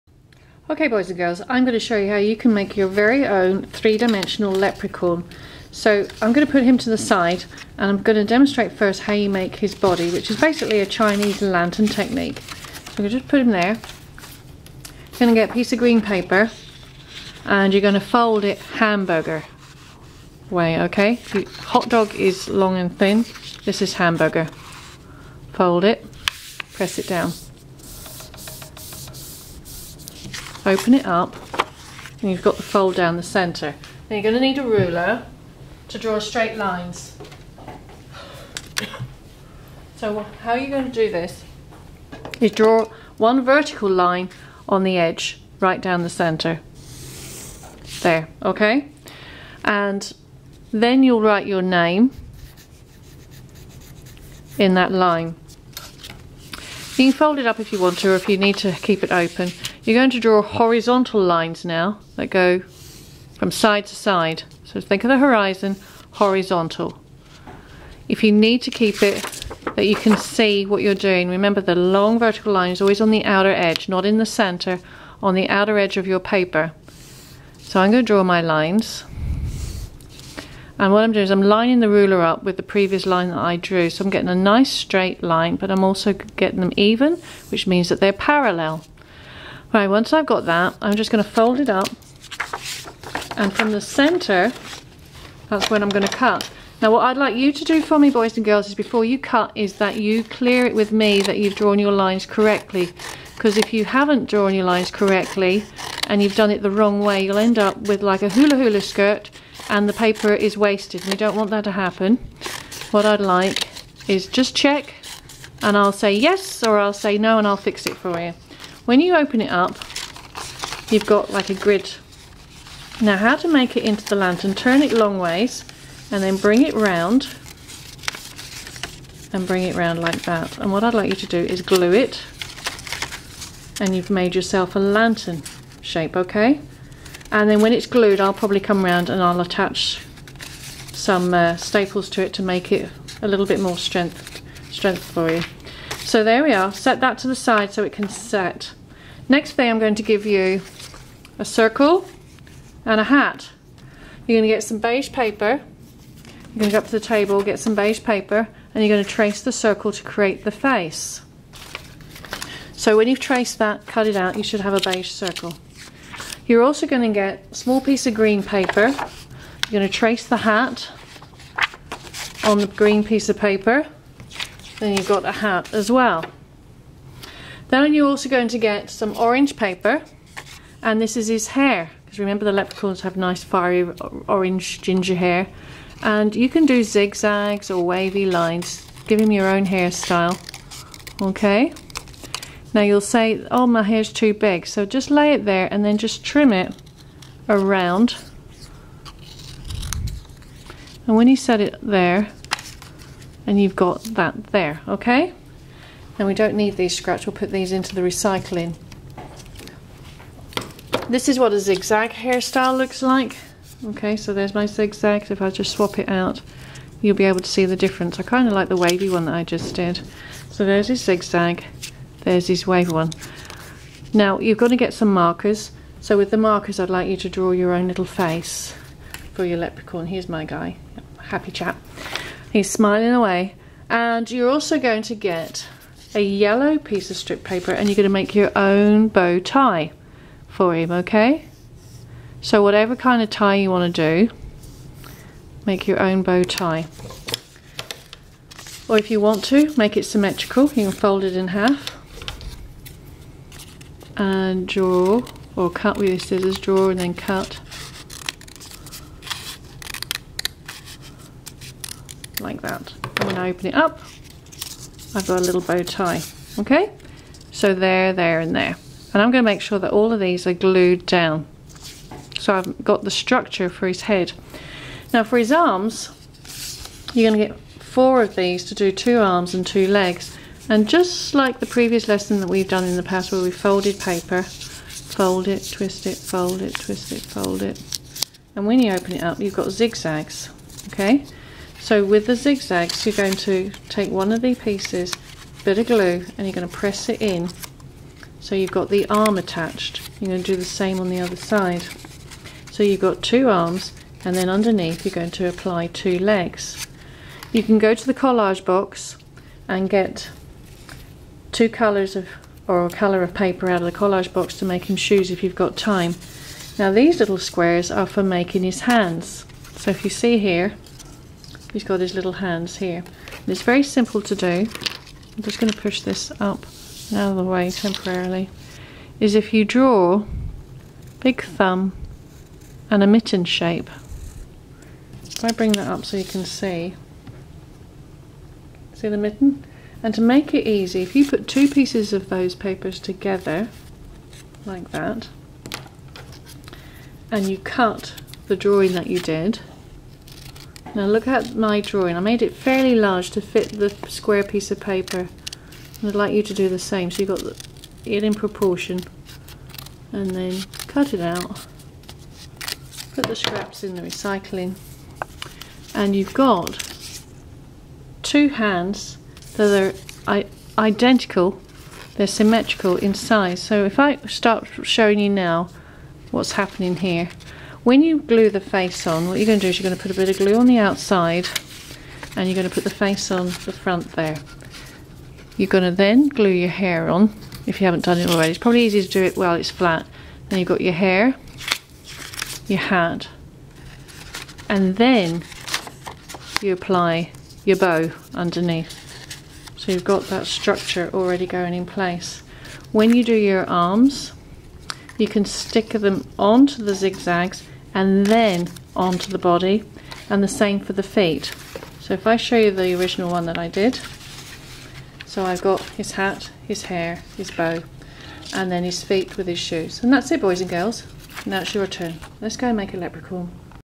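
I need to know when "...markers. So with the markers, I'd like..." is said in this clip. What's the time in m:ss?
3:45.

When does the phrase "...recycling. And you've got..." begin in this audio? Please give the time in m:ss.
6:04.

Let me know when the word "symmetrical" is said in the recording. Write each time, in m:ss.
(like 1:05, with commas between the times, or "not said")
4:10, 6:12.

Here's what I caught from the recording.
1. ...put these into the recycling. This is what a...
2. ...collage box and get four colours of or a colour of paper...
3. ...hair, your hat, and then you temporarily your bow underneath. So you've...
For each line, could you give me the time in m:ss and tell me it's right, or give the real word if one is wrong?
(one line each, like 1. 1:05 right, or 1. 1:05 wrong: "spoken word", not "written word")
1. 3:27 right
2. 5:08 wrong: "two", not "four"
3. 6:30 wrong: "apply", not "temporarily".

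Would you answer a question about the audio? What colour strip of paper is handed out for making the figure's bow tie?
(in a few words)
yellow.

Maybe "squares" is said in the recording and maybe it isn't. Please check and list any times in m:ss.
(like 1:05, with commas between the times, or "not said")
5:17, 5:54.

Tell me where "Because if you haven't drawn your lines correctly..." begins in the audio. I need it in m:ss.
1:43.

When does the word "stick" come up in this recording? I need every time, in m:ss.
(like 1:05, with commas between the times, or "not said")
6:45.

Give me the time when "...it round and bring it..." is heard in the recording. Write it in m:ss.
2:06.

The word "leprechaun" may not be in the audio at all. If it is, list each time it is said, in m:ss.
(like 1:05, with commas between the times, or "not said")
0:04, 3:02, 3:49, 7:02.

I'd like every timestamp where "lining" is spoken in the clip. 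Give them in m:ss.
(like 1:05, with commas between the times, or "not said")
1:21.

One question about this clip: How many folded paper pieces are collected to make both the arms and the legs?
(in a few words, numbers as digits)
4.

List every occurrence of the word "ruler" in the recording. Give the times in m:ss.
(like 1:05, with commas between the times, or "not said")
0:34, 1:21.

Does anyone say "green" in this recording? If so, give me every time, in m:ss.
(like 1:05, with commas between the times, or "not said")
0:15, 2:48, 2:52.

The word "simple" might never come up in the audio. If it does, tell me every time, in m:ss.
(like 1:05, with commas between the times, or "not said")
5:23.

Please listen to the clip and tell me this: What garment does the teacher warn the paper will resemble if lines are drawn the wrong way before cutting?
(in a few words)
hula skirt.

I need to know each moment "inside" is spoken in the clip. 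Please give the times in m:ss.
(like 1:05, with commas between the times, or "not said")
not said.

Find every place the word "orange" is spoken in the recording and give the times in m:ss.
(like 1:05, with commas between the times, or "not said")
2:59, 3:04.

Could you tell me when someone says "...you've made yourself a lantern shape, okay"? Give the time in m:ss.
2:13.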